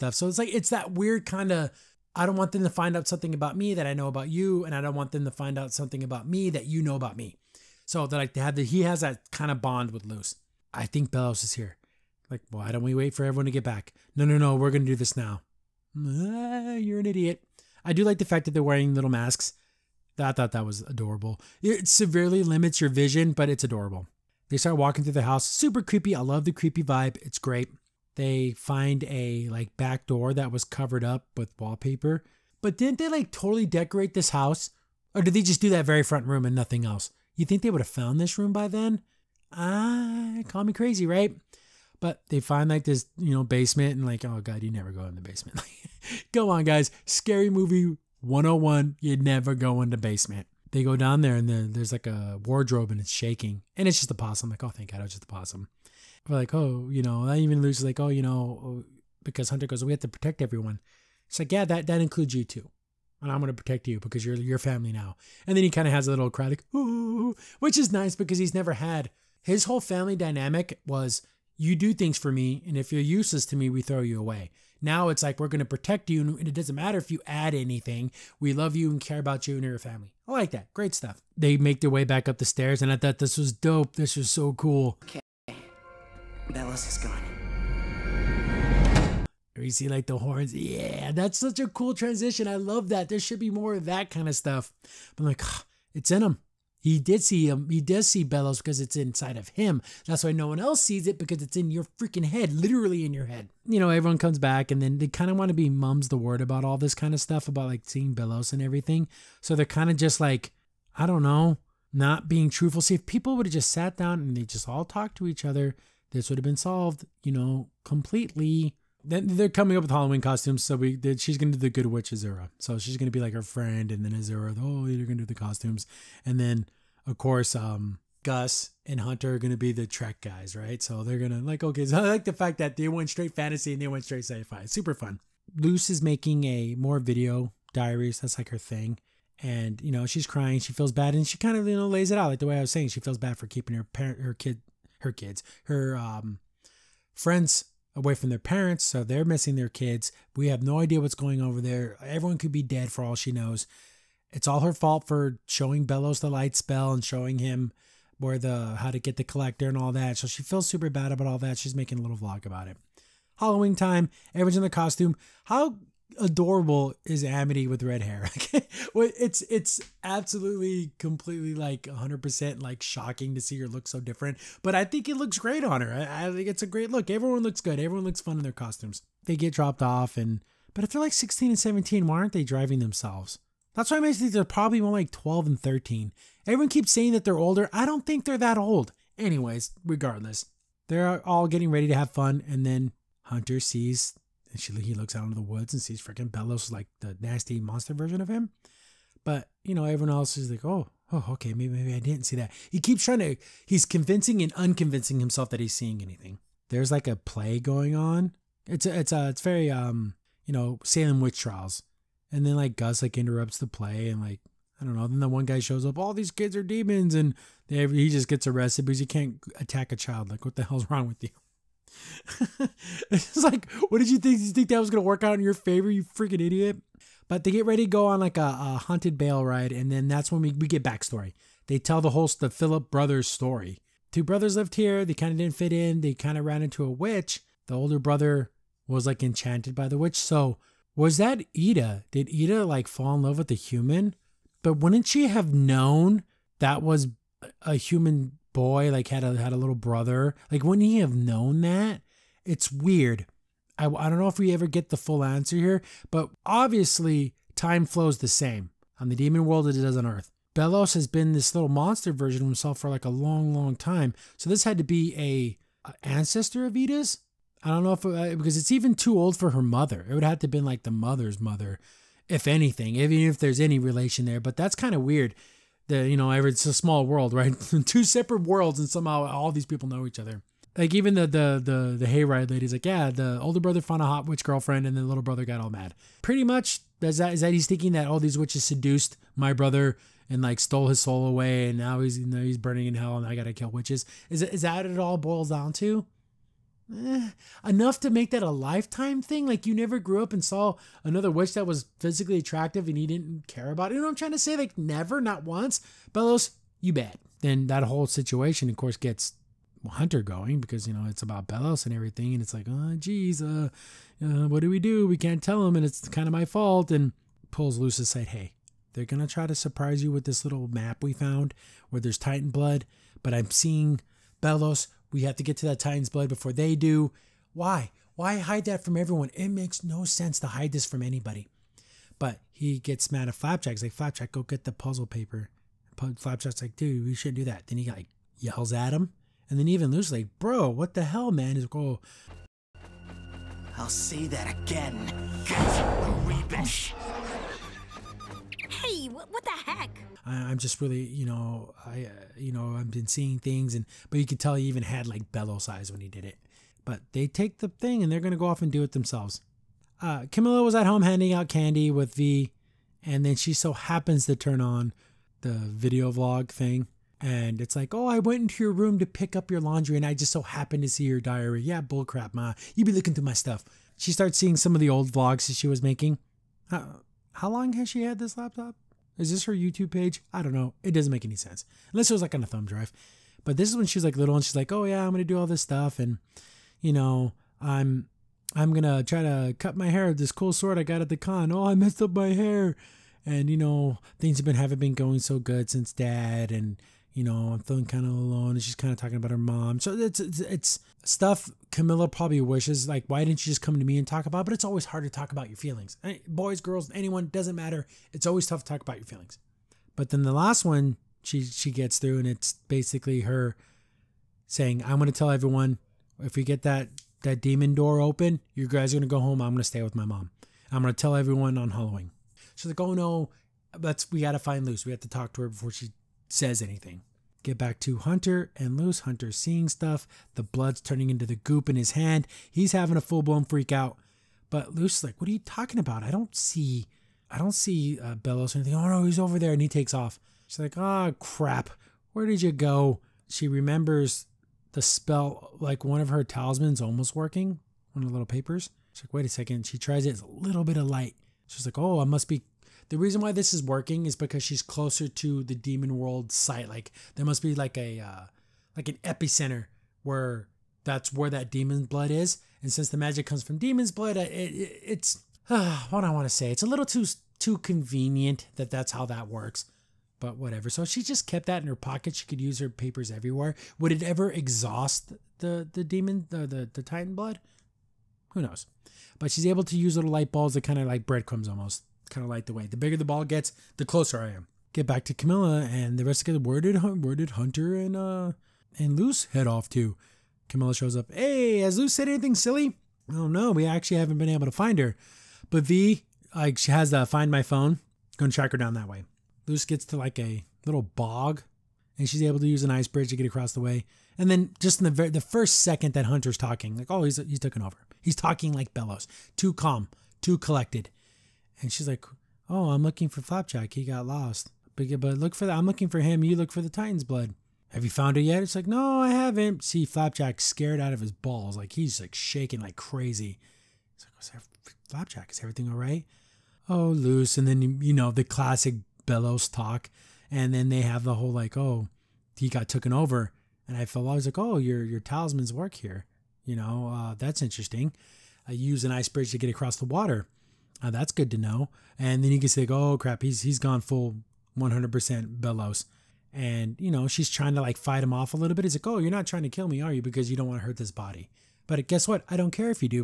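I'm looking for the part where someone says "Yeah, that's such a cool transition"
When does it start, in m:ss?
1:30.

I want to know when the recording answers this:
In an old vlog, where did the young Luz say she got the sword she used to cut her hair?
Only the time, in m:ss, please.
6:30.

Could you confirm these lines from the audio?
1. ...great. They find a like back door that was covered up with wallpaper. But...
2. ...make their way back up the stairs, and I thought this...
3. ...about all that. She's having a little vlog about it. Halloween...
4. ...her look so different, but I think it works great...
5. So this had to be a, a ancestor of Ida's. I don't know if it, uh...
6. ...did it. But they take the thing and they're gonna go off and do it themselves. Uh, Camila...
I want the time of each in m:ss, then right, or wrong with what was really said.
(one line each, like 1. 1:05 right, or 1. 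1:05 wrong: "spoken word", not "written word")
1. 0:27 right
2. 1:21 right
3. 2:41 wrong: "making", not "having"
4. 2:53 wrong: "looks", not "works"
5. 4:24 right
6. 5:56 right.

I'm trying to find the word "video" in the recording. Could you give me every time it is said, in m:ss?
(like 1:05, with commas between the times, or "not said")
2:16, 6:05.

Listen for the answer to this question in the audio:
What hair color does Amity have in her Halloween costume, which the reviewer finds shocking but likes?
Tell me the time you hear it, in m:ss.
2:47.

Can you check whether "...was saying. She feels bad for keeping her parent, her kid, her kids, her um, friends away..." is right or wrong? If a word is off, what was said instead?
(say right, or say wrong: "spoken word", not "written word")
right.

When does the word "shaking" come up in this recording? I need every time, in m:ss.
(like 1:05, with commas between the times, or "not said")
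0:53, 8:42.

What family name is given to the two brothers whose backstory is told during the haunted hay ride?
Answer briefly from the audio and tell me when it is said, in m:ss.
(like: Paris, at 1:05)
Philip, at 3:52.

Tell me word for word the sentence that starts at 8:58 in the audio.
I use an ice bridge to get across the water.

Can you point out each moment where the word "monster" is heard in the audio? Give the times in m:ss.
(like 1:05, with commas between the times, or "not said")
3:17, 4:21.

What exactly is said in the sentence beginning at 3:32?
And then like Gus like interrupts the play and like I don't know.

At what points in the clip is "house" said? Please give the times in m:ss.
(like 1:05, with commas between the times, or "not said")
0:25, 0:34.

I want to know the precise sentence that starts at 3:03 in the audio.
That's why I think they're probably more like 12 and 13.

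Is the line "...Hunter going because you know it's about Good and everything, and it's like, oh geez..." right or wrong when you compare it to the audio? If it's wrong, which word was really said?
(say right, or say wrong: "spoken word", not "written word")
wrong: "Belos", not "Good".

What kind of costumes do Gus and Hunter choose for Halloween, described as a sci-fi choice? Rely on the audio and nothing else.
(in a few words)
The Trek guys.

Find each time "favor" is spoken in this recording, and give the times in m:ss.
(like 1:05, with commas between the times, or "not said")
3:45.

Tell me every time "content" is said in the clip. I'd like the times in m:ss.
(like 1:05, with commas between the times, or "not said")
not said.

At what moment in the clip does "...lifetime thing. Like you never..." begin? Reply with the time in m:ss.
4:58.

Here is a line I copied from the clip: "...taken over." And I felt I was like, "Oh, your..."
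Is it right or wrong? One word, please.
right.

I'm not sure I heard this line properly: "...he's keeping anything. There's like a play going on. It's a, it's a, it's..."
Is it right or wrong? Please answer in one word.
wrong.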